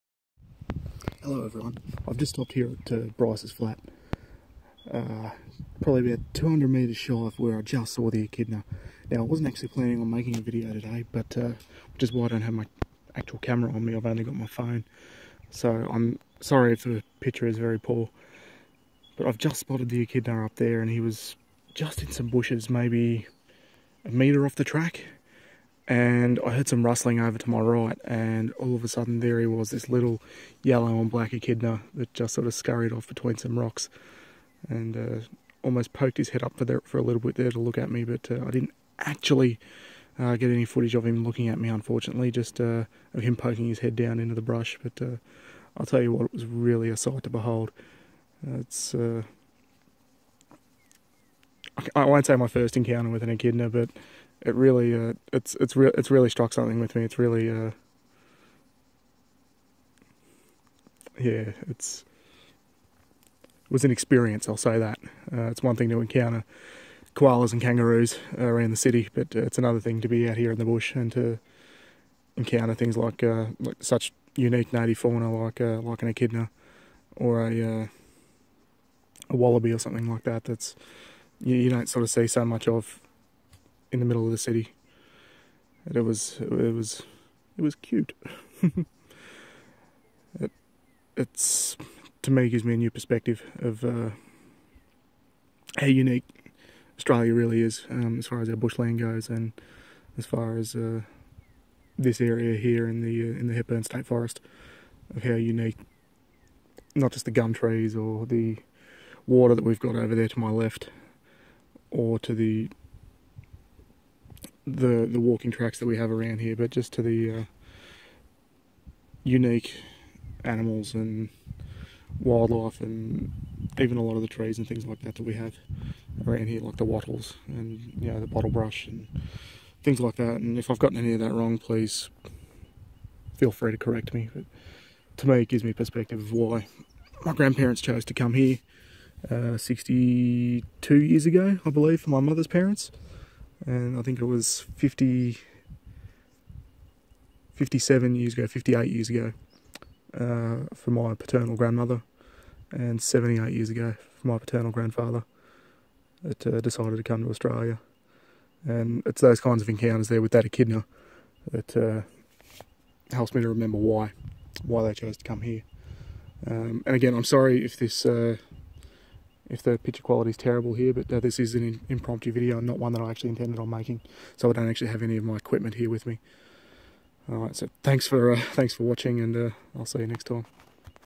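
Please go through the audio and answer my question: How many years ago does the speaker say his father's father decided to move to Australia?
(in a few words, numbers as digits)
78 years.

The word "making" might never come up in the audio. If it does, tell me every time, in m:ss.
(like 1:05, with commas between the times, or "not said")
0:10, 2:53.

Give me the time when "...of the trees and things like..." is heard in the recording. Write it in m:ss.
2:04.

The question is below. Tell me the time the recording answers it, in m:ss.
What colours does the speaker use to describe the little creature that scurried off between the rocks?
0:30.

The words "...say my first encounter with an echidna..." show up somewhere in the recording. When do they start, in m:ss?
0:52.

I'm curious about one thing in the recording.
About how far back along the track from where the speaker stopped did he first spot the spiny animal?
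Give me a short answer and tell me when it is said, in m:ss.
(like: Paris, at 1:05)
200 metres, at 0:06.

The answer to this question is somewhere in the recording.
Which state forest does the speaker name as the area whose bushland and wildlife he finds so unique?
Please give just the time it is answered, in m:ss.
1:43.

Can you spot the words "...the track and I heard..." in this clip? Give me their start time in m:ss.
0:24.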